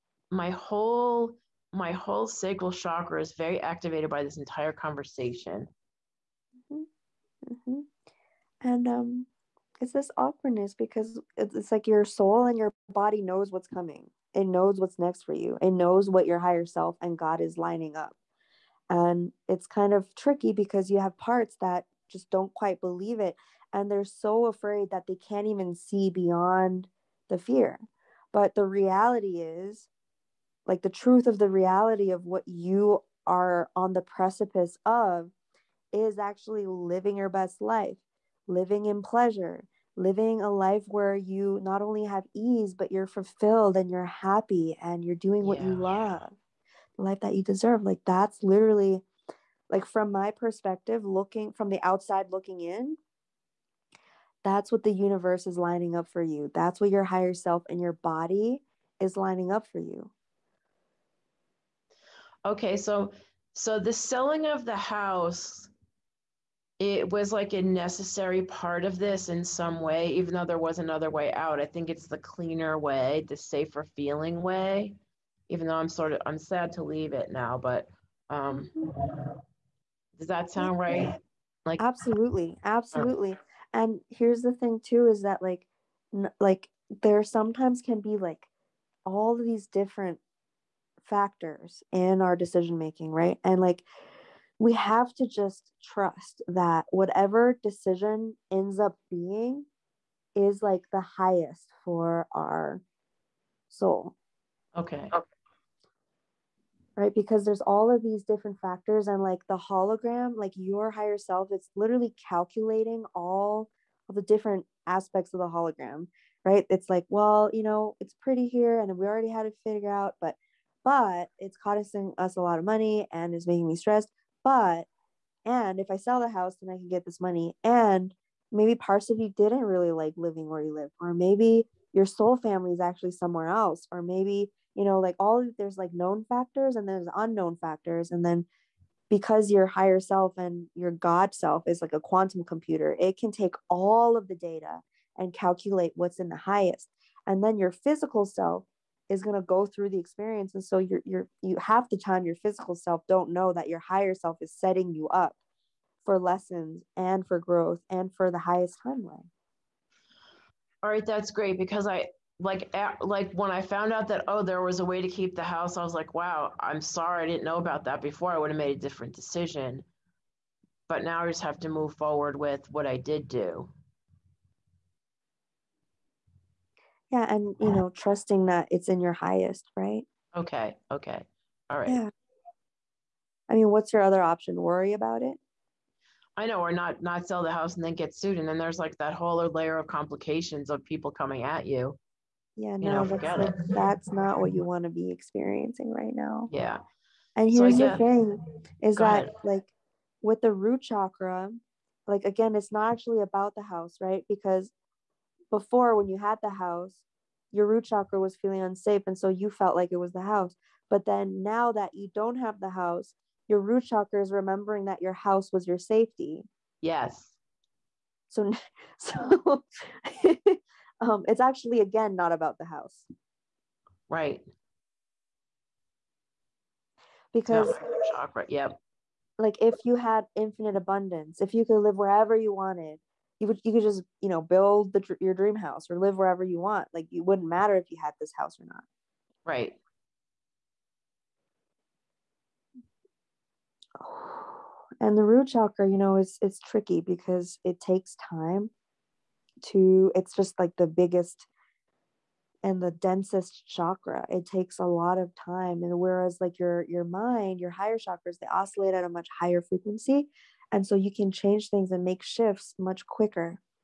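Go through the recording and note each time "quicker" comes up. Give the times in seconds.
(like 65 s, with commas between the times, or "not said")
263 s.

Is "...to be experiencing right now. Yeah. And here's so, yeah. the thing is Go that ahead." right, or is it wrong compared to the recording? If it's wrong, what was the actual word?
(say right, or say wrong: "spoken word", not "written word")
right.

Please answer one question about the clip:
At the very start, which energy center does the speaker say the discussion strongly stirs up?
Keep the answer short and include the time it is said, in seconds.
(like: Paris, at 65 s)
sacral chakra, at 2 s.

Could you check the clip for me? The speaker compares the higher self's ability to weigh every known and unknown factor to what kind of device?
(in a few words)
quantum computer.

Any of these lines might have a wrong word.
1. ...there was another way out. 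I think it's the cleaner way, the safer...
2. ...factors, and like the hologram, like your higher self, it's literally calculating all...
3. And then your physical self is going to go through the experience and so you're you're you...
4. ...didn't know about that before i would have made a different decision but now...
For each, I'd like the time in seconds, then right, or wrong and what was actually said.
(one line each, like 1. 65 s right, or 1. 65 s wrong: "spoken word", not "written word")
1. 70 s right
2. 108 s right
3. 147 s right
4. 167 s right.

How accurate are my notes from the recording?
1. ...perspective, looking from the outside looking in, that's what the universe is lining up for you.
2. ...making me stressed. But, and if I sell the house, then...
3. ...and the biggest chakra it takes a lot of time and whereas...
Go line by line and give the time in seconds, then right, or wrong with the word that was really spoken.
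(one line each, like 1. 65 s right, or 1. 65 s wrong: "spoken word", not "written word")
1. 50 s right
2. 123 s right
3. 252 s wrong: "densest", not "biggest".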